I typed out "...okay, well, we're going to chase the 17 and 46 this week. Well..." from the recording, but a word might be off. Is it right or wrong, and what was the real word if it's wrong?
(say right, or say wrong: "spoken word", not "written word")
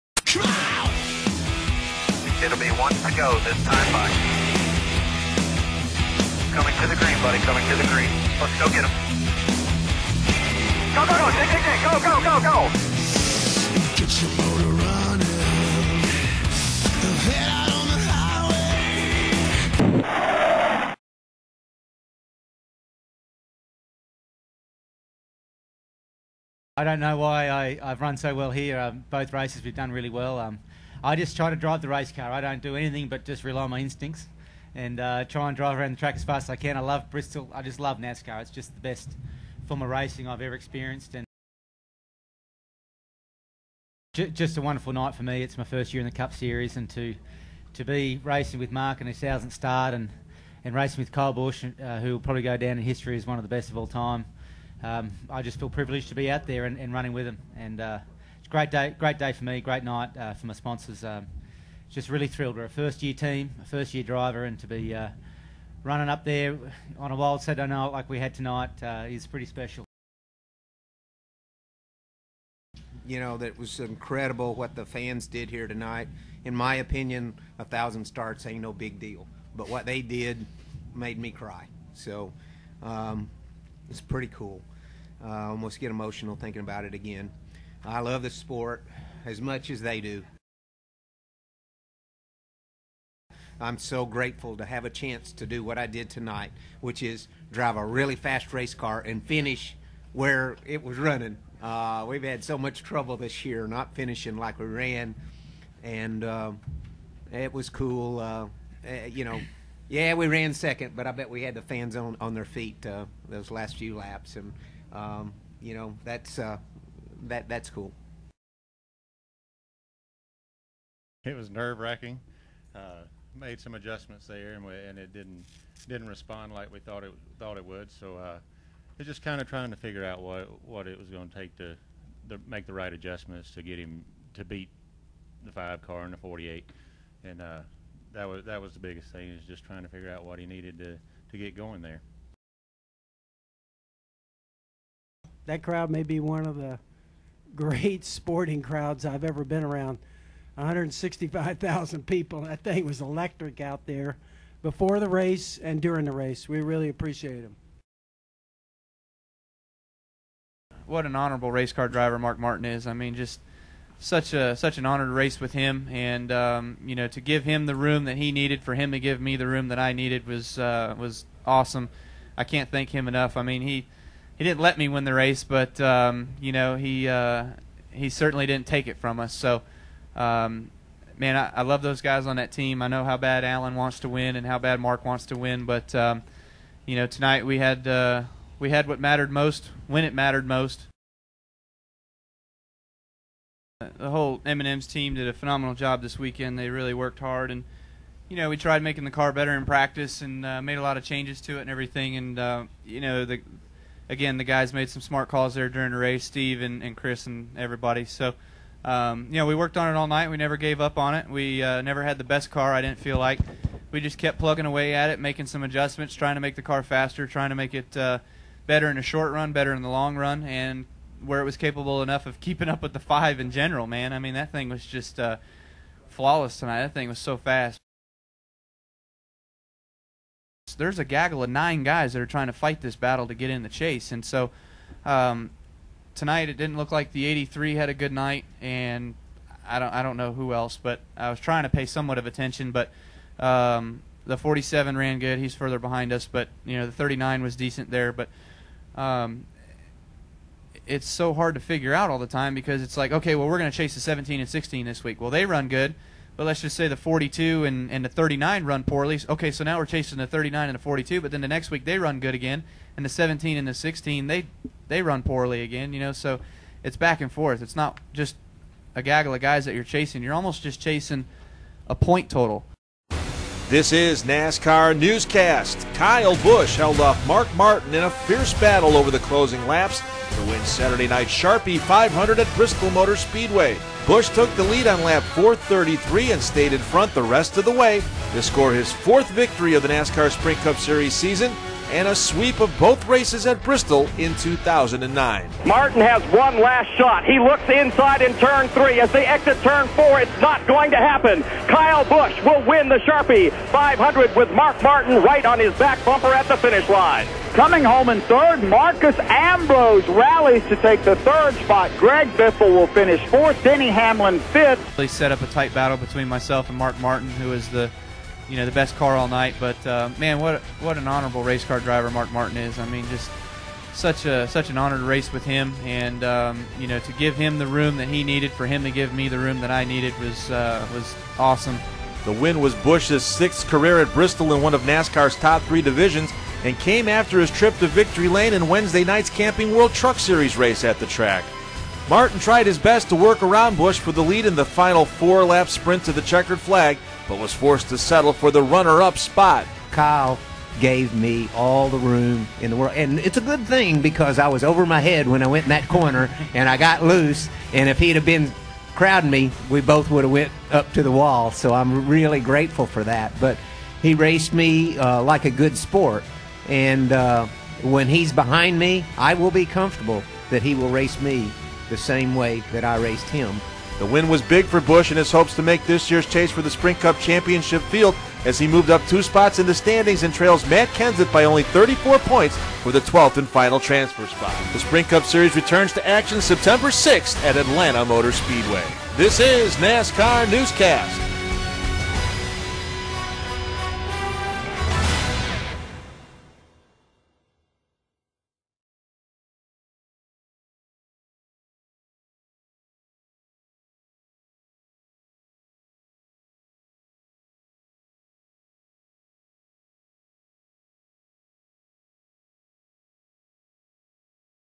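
wrong: "16", not "46".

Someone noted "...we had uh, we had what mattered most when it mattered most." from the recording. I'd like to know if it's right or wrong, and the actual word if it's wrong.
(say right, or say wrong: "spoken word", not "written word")
right.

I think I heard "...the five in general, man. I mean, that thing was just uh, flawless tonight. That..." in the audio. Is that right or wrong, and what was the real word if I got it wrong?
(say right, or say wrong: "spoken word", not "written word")
right.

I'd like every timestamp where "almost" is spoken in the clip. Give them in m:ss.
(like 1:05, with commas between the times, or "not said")
1:25, 4:30.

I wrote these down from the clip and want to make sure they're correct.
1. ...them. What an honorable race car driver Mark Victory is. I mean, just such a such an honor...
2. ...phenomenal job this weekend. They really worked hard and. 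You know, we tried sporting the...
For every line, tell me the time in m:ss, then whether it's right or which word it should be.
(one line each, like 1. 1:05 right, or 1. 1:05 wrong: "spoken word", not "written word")
1. 2:37 wrong: "Martin", not "Victory"
2. 3:15 wrong: "making", not "sporting".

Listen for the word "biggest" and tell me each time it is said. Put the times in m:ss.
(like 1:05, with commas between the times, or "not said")
2:18.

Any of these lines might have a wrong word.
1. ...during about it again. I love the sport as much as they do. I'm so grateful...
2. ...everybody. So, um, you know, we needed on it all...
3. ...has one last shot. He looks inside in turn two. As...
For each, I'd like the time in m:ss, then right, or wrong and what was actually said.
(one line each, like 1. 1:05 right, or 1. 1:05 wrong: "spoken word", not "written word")
1. 1:26 wrong: "thinking", not "during"
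2. 3:27 wrong: "worked", not "needed"
3. 4:56 wrong: "three", not "two".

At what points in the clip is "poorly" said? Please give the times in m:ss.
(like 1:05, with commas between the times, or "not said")
4:18, 4:25.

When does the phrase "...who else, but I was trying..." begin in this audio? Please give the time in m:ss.
4:00.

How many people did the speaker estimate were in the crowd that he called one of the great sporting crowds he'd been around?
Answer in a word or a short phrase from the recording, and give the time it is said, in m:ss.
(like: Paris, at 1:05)
165,000, at 2:30.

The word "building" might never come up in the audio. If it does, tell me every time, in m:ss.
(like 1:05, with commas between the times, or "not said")
not said.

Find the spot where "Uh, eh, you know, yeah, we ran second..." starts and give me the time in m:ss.
1:48.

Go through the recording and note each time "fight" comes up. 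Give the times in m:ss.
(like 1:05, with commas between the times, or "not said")
3:52.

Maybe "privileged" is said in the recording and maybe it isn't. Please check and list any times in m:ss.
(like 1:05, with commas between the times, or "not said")
0:55.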